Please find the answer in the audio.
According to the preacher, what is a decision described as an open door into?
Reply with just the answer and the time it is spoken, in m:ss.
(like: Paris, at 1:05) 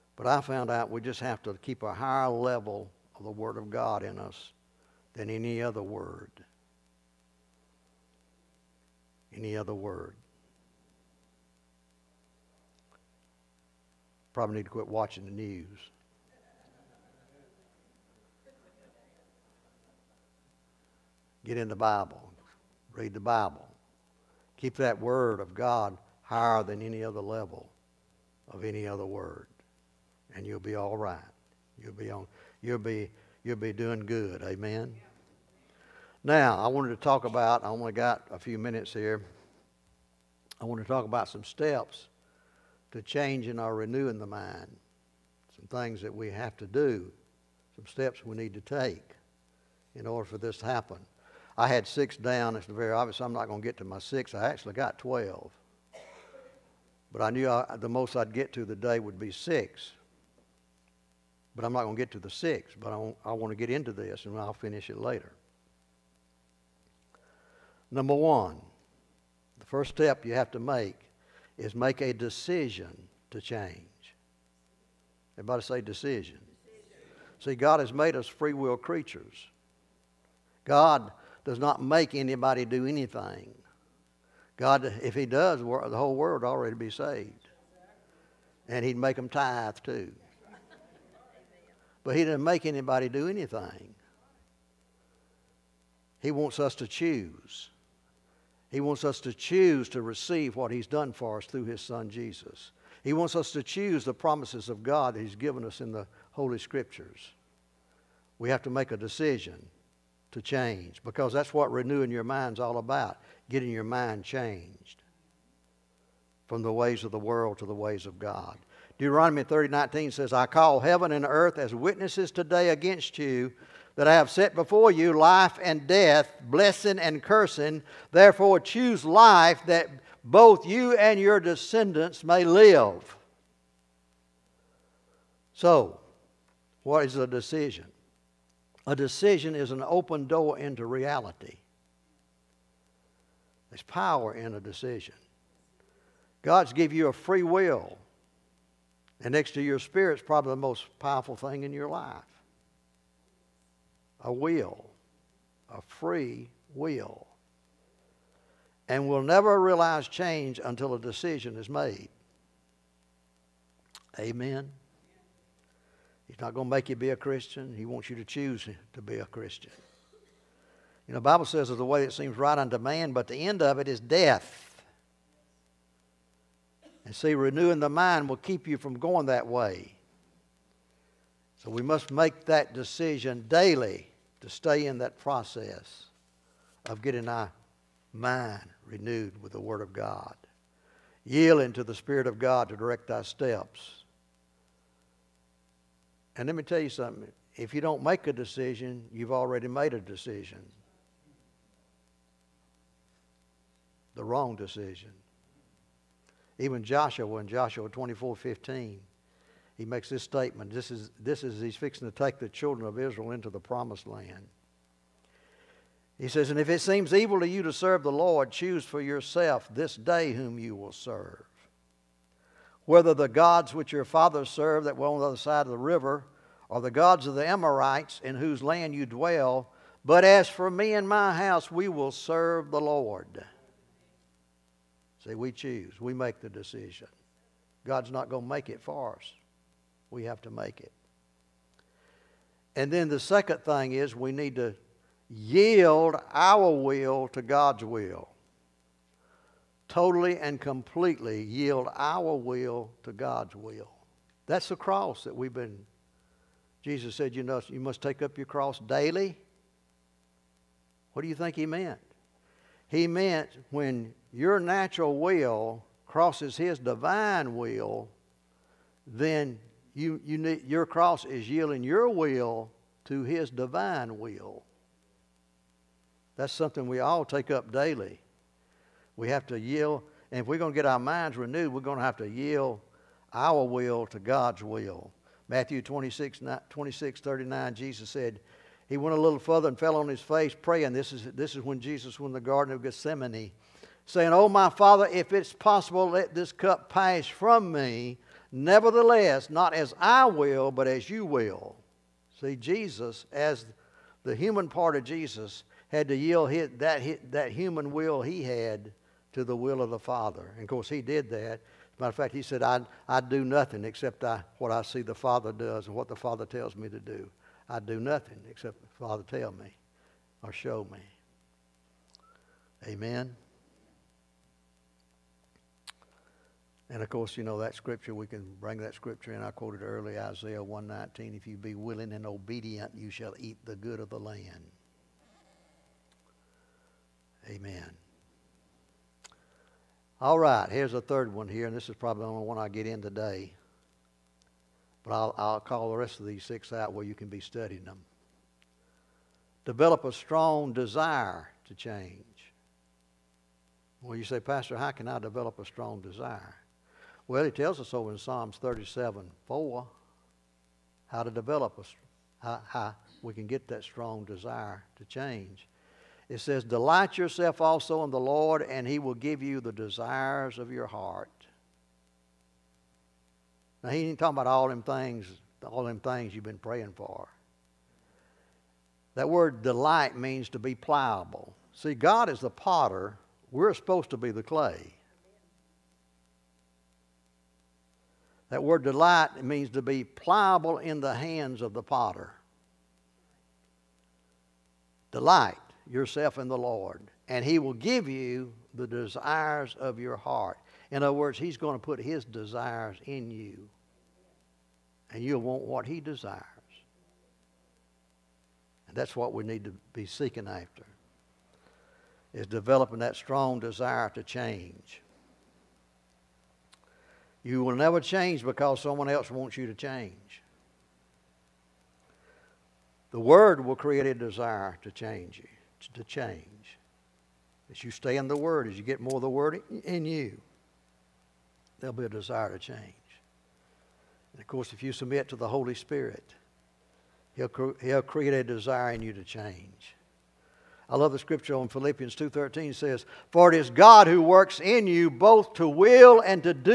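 Reality, at 2:20.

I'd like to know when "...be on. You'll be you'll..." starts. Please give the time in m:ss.
0:31.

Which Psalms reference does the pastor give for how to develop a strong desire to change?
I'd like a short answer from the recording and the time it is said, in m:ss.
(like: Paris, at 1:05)
Psalms 37:4, at 5:58.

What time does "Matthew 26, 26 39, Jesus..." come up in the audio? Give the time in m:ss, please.
4:45.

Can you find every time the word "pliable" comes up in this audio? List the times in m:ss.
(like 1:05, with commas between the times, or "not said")
6:20, 6:30.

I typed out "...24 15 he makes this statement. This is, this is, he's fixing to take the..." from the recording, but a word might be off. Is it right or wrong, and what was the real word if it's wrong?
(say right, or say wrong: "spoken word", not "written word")
right.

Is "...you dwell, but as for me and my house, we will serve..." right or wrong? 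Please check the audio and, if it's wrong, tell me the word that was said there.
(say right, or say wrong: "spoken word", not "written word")
right.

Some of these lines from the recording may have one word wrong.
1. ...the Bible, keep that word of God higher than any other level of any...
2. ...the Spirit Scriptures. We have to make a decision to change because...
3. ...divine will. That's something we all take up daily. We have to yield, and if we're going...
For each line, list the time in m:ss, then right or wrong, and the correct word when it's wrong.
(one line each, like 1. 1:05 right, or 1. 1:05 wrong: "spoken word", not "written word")
1. 0:23 right
2. 1:45 wrong: "Holy", not "Spirit"
3. 4:33 right.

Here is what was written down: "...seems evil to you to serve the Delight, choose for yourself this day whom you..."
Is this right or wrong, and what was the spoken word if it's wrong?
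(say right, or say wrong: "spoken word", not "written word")
wrong: "Lord", not "Delight".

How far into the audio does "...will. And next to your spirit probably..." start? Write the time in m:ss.
2:27.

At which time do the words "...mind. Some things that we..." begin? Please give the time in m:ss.
0:44.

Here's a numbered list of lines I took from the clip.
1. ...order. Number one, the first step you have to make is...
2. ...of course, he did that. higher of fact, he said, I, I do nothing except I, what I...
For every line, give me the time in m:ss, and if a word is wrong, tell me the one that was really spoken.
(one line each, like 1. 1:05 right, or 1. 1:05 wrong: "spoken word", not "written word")
1. 1:04 wrong: "later", not "order"
2. 5:10 wrong: "matter", not "higher".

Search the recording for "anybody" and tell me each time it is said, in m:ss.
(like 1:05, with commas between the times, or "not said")
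1:22, 1:32.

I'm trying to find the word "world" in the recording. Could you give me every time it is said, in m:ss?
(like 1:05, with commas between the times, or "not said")
1:26, 1:57.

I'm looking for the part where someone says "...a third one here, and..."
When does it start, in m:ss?
5:40.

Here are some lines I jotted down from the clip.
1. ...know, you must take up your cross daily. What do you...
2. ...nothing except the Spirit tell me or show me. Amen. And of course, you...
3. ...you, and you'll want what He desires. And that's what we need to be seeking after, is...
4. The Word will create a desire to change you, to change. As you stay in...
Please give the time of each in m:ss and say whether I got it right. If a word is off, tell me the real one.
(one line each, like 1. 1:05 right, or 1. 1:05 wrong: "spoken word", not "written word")
1. 4:17 right
2. 5:17 wrong: "Father", not "Spirit"
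3. 6:43 right
4. 7:03 right.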